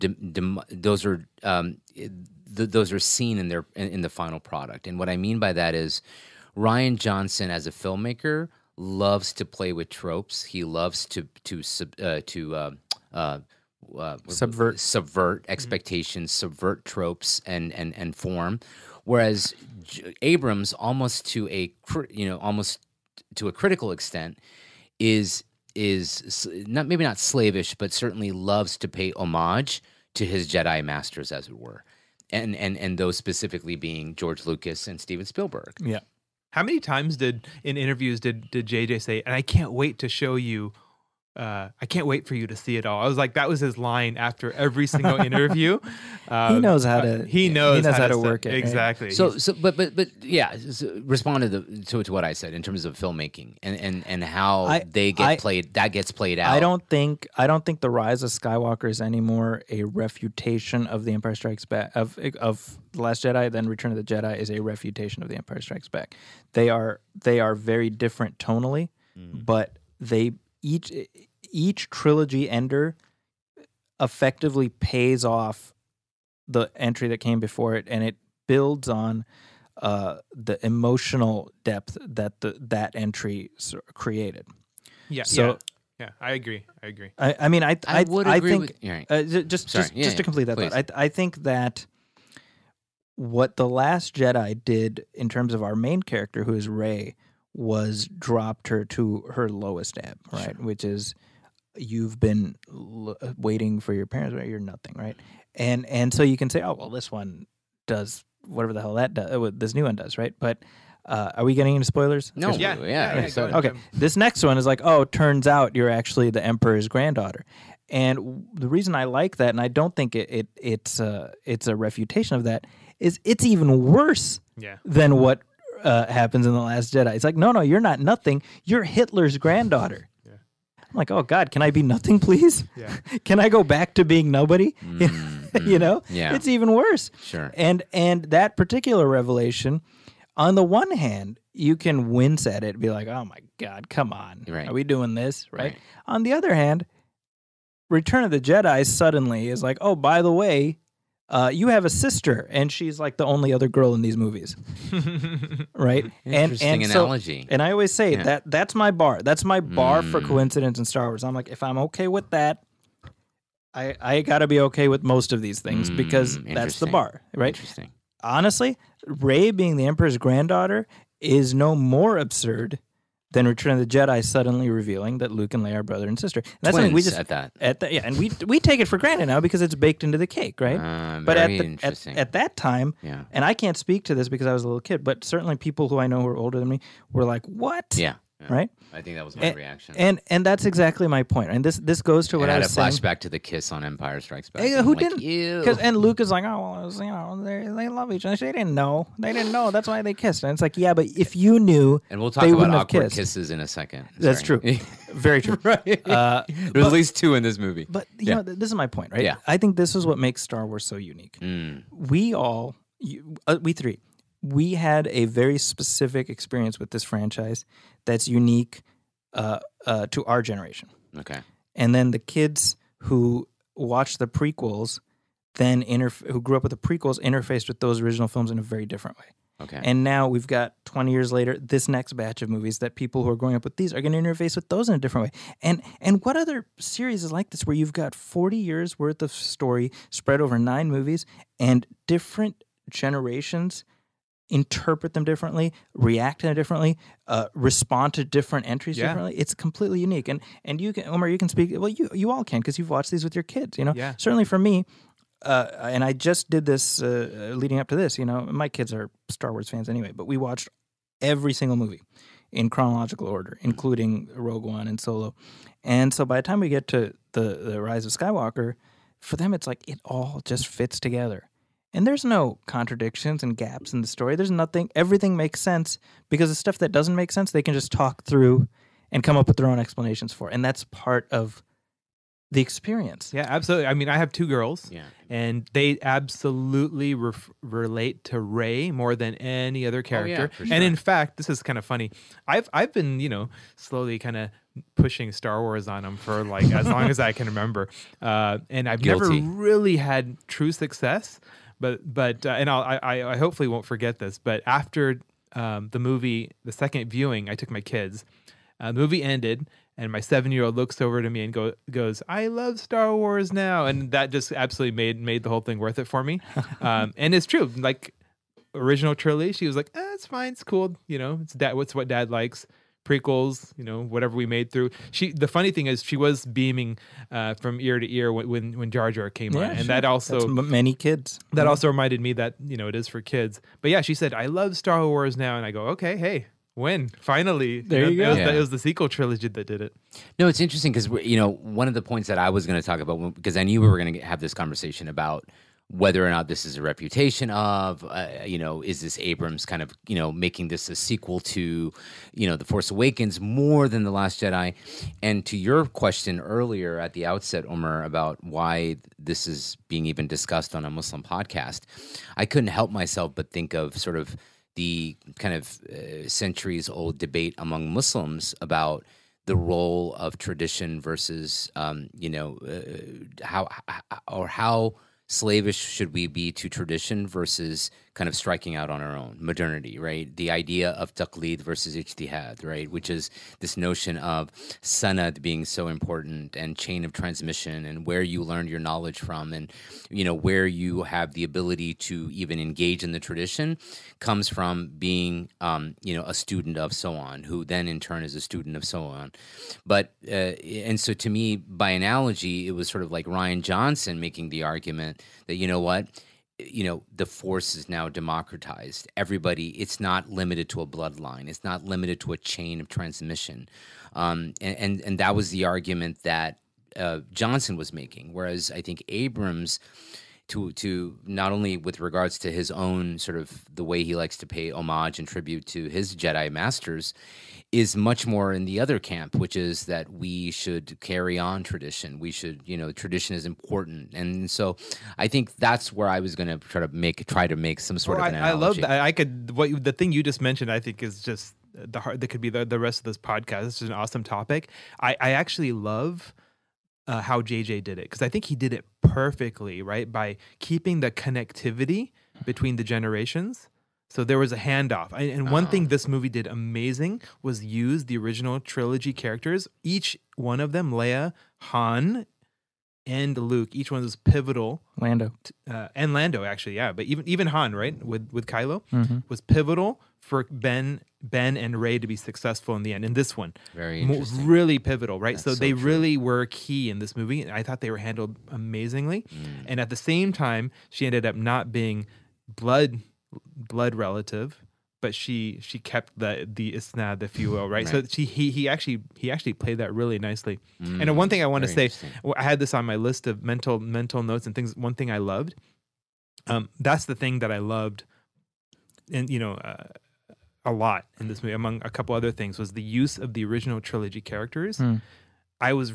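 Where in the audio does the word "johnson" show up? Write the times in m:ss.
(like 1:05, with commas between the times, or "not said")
0:06, 6:43, 6:57.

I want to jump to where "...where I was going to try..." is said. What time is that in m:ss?
7:15.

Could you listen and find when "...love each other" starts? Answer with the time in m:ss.
3:17.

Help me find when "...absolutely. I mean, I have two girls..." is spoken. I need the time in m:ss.
4:43.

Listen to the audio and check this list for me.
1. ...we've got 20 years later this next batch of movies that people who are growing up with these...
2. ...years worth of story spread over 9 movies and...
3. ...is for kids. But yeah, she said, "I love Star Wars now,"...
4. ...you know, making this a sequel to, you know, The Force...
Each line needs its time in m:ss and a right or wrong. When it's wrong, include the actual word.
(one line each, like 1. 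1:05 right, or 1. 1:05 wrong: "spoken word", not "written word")
1. 3:50 right
2. 3:58 right
3. 5:32 right
4. 5:50 right.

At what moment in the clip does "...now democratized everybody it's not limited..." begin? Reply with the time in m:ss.
6:47.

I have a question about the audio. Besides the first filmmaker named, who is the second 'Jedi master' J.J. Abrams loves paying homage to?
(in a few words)
Steven Spielberg.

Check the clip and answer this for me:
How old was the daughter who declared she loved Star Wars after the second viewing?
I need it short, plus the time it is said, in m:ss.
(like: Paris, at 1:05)
7, at 5:10.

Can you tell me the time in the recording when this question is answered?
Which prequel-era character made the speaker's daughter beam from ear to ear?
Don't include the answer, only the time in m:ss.
5:28.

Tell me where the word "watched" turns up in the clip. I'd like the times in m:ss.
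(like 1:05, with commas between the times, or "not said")
3:43, 4:12, 4:20.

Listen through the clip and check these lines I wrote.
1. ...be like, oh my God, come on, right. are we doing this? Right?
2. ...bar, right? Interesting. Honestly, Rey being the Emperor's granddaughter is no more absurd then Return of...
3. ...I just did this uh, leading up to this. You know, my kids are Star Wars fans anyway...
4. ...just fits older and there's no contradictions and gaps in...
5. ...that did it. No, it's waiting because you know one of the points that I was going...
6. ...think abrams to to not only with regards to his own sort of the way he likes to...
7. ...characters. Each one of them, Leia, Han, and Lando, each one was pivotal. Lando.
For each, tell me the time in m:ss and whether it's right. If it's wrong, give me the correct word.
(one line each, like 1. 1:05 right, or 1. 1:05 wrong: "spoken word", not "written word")
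1. 2:22 right
2. 2:46 right
3. 4:16 right
4. 4:30 wrong: "together", not "older"
5. 5:39 wrong: "interesting", not "waiting"
6. 6:58 right
7. 7:39 wrong: "Luke", not "Lando".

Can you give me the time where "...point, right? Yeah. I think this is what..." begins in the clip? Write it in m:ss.
3:28.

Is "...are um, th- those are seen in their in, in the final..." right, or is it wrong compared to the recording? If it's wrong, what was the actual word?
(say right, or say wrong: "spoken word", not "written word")
right.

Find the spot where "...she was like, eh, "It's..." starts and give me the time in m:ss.
5:19.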